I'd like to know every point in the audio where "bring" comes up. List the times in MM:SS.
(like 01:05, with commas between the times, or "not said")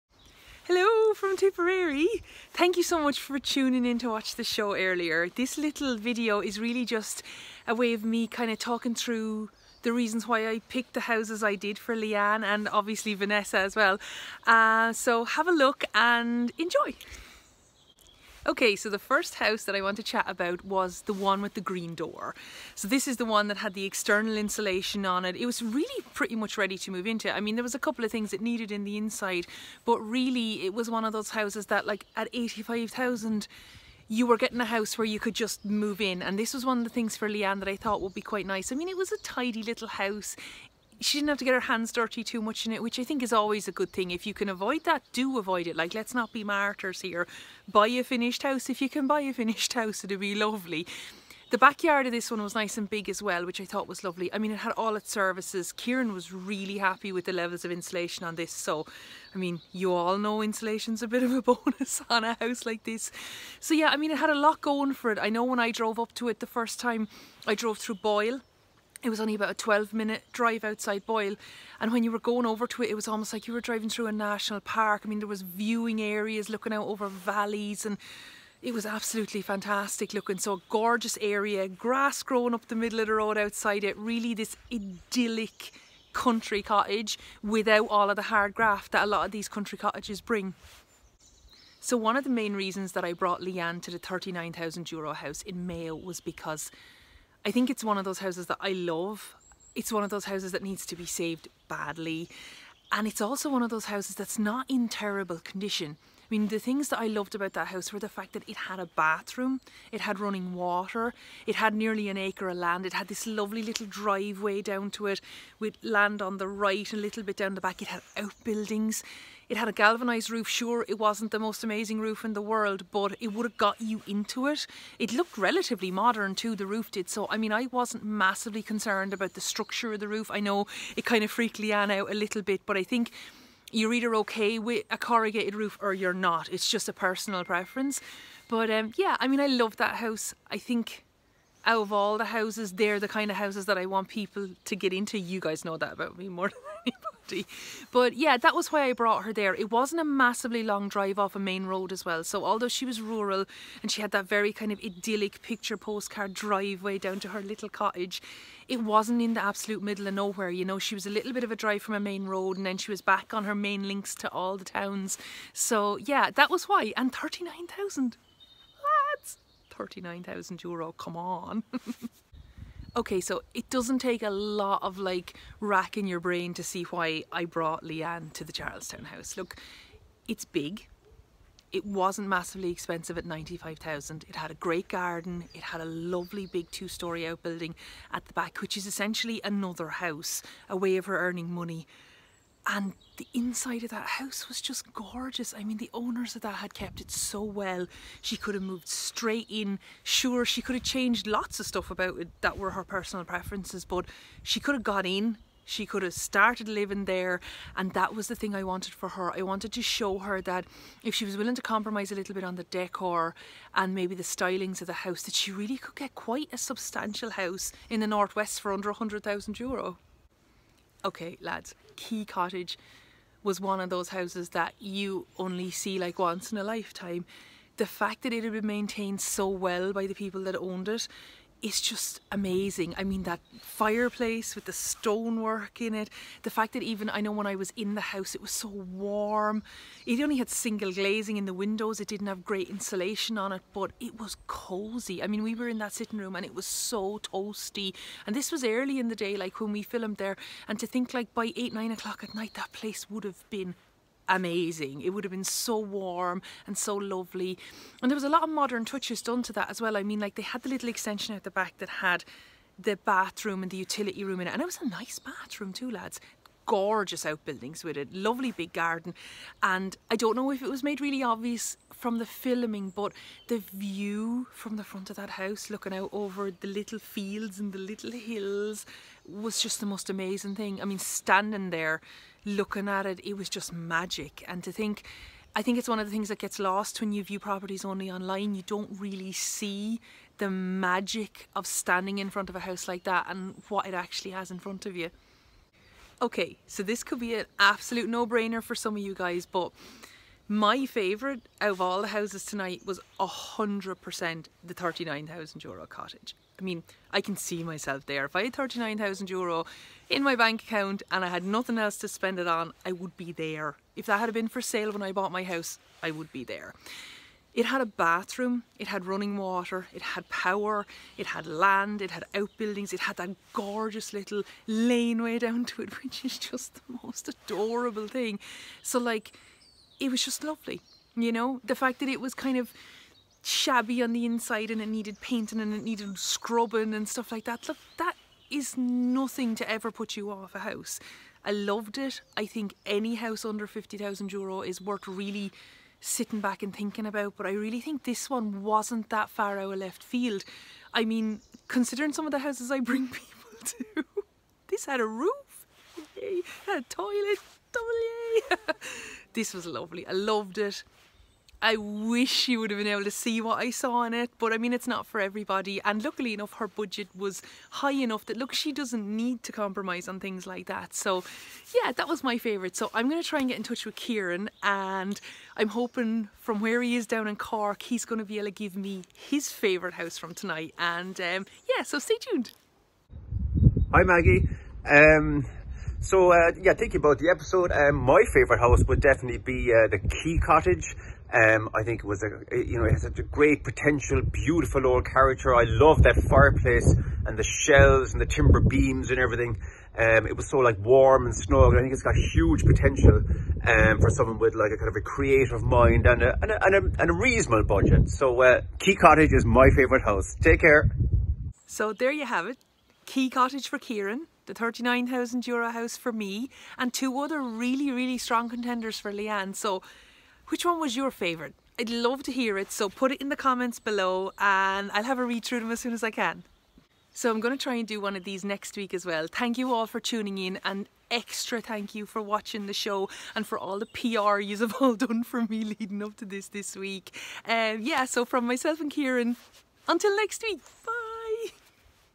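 01:30, 05:52.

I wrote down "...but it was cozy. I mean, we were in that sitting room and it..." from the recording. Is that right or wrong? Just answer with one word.
right.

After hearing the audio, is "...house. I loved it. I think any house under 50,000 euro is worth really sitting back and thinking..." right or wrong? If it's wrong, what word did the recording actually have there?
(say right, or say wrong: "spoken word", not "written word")
right.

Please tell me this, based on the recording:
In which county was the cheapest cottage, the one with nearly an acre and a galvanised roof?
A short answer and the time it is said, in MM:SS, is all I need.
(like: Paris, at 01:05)
Mayo, at 01:35.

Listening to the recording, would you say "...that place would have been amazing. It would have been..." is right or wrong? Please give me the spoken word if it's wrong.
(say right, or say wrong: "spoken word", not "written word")
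right.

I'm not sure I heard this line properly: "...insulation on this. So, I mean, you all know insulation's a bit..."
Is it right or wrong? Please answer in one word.
right.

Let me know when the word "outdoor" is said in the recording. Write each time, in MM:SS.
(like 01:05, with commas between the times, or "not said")
not said.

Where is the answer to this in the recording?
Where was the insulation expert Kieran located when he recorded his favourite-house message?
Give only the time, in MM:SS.
06:17.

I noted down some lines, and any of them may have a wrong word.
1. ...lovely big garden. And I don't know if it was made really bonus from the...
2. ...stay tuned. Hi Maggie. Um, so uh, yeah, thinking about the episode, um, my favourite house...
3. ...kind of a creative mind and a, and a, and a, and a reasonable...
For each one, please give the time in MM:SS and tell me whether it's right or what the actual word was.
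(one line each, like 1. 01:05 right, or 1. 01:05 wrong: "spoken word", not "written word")
1. 04:28 wrong: "obvious", not "bonus"
2. 06:21 right
3. 06:44 right.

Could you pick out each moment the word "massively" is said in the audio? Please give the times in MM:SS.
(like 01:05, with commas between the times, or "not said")
02:08, 02:30, 03:02.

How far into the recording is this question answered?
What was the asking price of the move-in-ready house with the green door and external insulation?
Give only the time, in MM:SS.
00:32.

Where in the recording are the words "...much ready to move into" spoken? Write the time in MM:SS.
00:26.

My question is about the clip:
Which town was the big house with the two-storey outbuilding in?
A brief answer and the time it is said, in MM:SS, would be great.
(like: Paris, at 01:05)
Charlestown, at 02:58.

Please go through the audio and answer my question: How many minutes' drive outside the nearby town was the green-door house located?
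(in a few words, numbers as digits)
12.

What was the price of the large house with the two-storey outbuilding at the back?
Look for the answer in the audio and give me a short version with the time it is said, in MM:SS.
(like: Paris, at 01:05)
95,000, at 03:03.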